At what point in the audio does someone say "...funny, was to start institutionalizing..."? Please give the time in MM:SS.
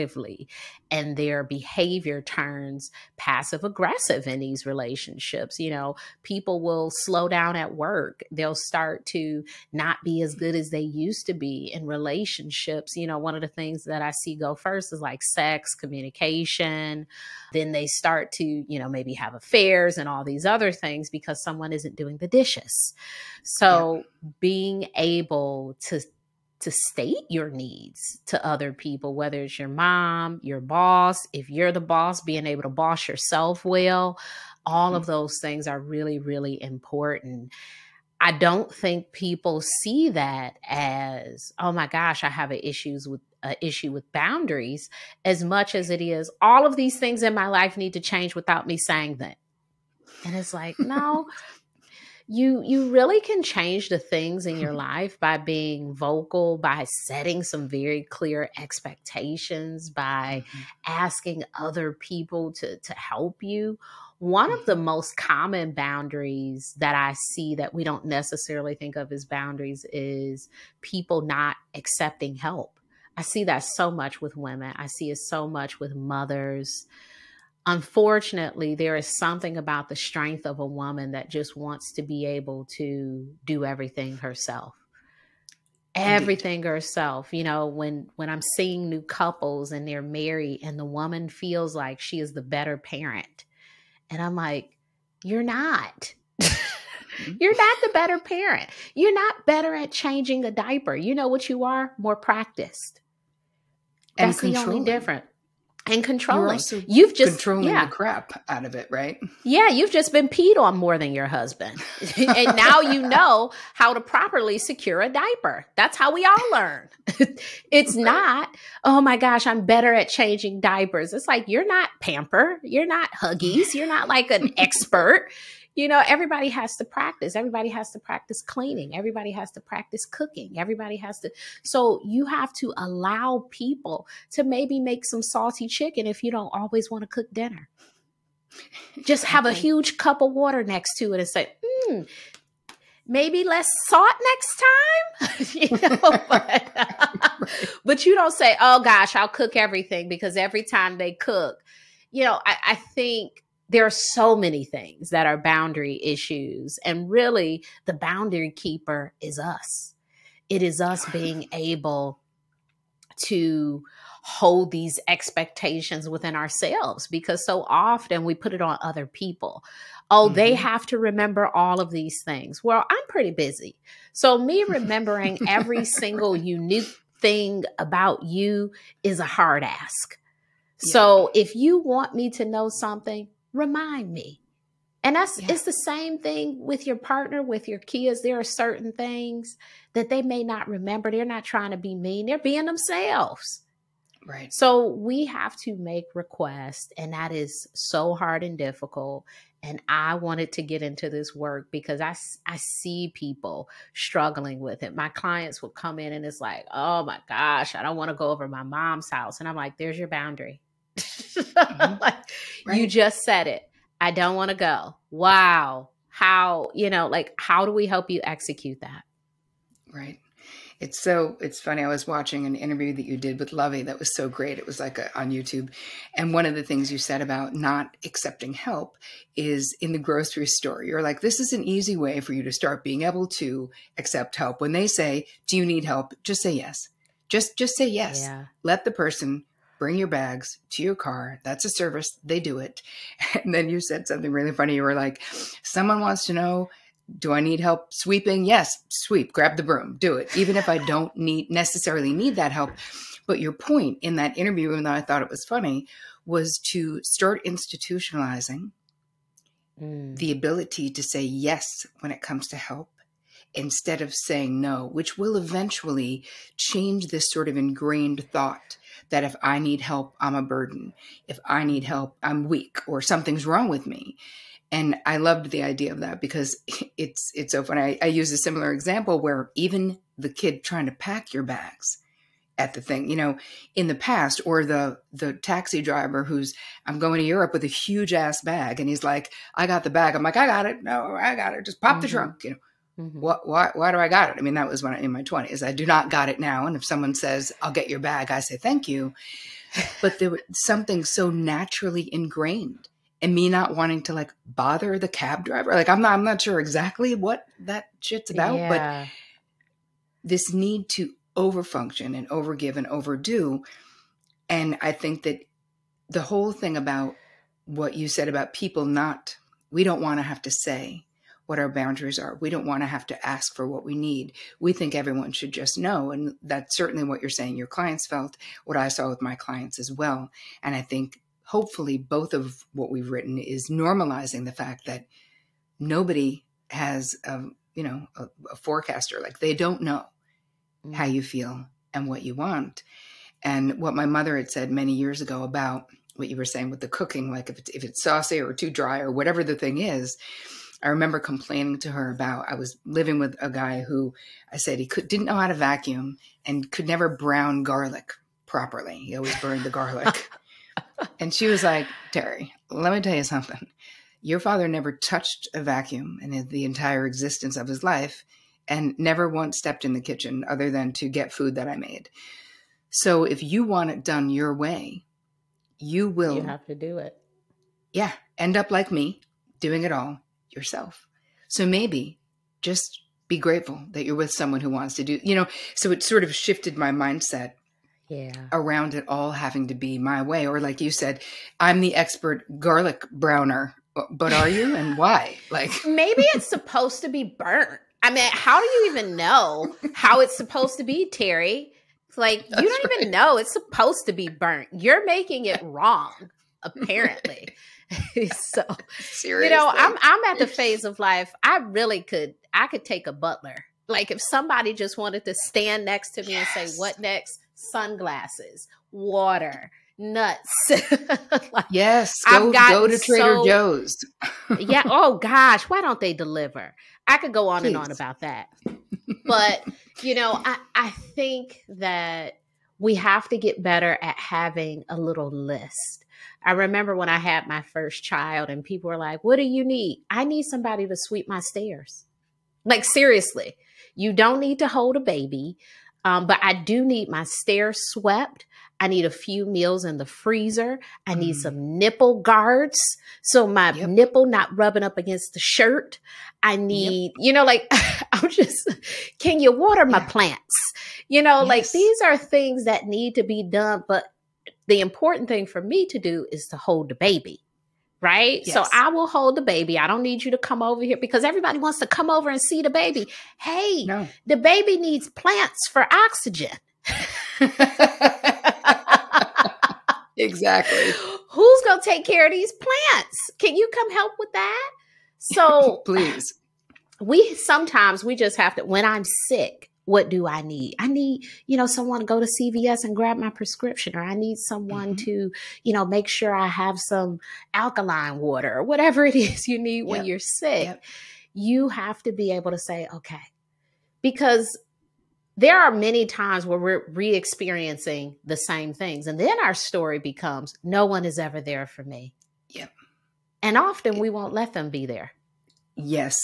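04:15.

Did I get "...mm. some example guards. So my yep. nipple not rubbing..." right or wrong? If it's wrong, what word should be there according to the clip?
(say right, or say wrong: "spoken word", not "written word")
wrong: "nipple", not "example".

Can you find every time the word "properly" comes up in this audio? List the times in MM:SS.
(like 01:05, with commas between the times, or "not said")
01:53, 05:58.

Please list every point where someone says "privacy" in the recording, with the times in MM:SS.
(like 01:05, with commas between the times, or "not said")
not said.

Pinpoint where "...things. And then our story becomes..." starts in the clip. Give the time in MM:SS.
08:28.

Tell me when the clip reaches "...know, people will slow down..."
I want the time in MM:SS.
00:05.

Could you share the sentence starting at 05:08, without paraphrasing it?
but this need to overfunction and overgive and overdo.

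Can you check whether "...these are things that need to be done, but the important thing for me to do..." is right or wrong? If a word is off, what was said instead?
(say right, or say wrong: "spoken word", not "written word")
right.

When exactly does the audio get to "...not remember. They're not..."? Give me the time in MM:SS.
03:10.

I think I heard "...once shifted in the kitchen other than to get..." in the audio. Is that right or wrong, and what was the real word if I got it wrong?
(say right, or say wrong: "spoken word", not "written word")
wrong: "stepped", not "shifted".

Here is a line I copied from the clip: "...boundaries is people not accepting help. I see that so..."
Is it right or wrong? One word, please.
right.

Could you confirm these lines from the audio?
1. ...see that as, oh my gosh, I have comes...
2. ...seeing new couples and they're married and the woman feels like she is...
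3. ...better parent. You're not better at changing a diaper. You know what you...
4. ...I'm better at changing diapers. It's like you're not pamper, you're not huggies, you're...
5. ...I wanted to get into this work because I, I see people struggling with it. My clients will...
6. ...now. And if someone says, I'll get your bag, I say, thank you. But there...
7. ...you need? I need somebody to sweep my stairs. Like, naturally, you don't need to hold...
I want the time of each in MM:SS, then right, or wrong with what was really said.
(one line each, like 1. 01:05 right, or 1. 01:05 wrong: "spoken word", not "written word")
1. 00:39 wrong: "issues", not "comes"
2. 01:28 right
3. 01:37 right
4. 01:59 right
5. 03:19 right
6. 04:56 right
7. 07:19 wrong: "seriously", not "naturally".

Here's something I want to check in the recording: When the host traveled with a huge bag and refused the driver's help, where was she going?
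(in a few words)
Europe.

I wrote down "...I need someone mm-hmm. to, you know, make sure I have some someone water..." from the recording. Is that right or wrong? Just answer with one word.
wrong.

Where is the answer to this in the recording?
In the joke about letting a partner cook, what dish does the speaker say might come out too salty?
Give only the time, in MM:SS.
02:15.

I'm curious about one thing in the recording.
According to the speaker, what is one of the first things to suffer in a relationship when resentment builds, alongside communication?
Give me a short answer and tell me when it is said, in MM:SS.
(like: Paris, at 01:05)
Sex, at 00:15.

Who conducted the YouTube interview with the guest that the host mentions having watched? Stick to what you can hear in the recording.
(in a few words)
Lovey.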